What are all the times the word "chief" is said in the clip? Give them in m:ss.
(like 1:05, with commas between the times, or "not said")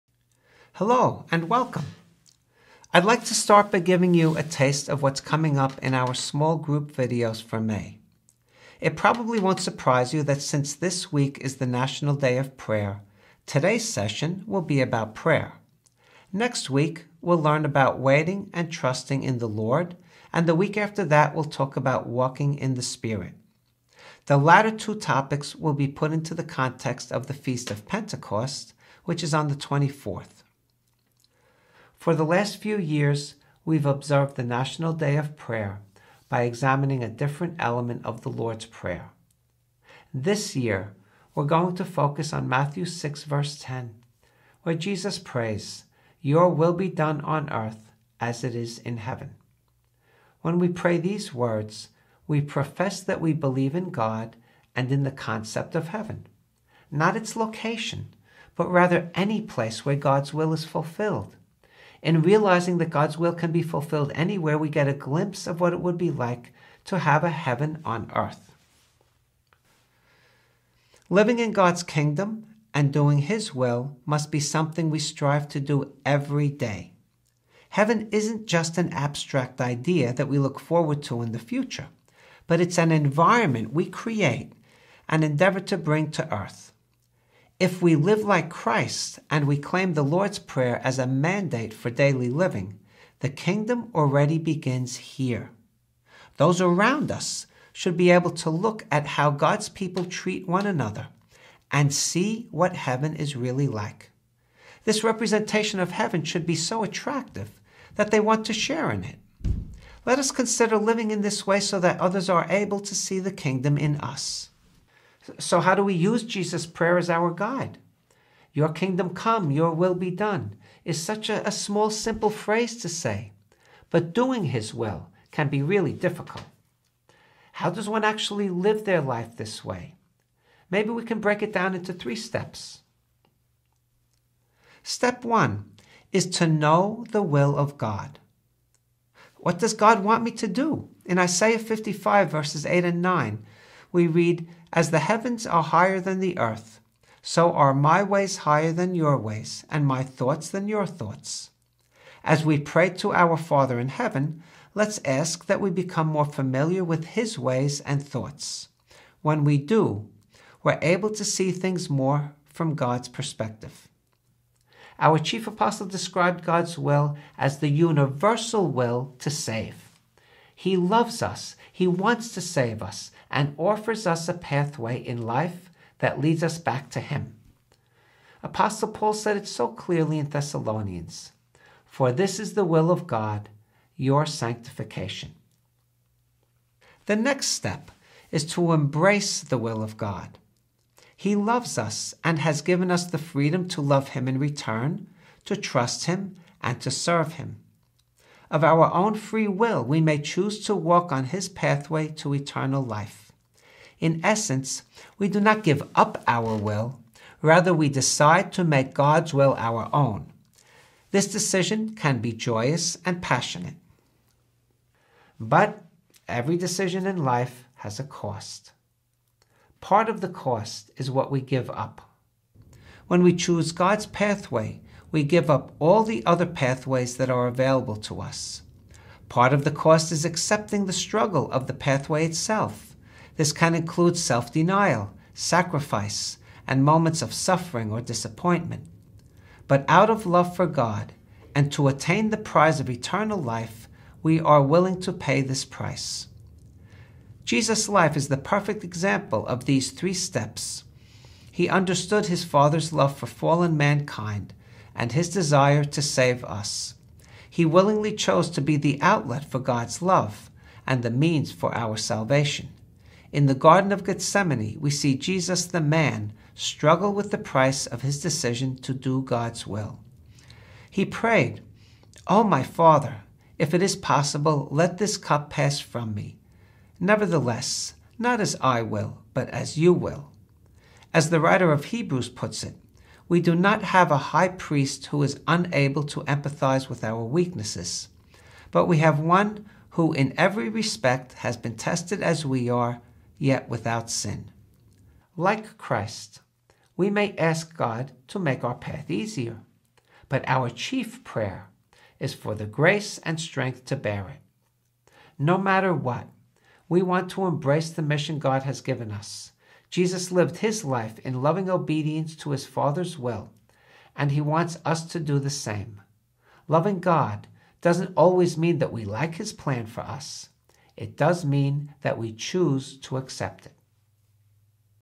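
2:45, 5:00.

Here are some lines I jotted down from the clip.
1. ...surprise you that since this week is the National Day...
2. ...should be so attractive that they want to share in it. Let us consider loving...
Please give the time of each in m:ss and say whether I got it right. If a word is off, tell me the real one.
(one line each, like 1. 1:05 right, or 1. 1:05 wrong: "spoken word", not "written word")
1. 0:09 right
2. 1:46 wrong: "living", not "loving".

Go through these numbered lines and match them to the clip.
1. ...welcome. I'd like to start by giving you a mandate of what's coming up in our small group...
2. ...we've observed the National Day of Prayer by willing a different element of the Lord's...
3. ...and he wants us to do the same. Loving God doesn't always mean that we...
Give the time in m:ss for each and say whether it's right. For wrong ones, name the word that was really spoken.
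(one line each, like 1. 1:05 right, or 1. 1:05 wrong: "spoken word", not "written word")
1. 0:01 wrong: "taste", not "mandate"
2. 0:33 wrong: "examining", not "willing"
3. 5:14 right.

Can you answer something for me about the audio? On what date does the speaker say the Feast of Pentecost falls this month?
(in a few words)
24th.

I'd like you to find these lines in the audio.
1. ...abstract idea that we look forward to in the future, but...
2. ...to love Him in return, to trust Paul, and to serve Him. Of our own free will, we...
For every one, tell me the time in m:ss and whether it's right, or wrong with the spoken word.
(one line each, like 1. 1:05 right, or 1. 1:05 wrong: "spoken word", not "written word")
1. 1:18 right
2. 3:13 wrong: "Him", not "Paul".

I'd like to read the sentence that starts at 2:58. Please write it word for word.
Apostle Paul said it so clearly in Thessalonians For this is the will of God, your sanctification.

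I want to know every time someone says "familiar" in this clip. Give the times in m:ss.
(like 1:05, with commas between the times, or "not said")
2:36.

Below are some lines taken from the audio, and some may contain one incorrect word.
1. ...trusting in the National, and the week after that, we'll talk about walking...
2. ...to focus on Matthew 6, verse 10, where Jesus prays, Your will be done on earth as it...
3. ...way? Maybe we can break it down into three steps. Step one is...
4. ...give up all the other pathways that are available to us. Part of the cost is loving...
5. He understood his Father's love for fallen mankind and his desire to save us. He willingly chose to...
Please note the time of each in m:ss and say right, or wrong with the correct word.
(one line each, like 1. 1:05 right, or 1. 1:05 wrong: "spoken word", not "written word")
1. 0:18 wrong: "Lord", not "National"
2. 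0:41 right
3. 2:09 right
4. 3:45 wrong: "accepting", not "loving"
5. 4:11 right.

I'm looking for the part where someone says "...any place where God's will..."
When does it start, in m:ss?
0:59.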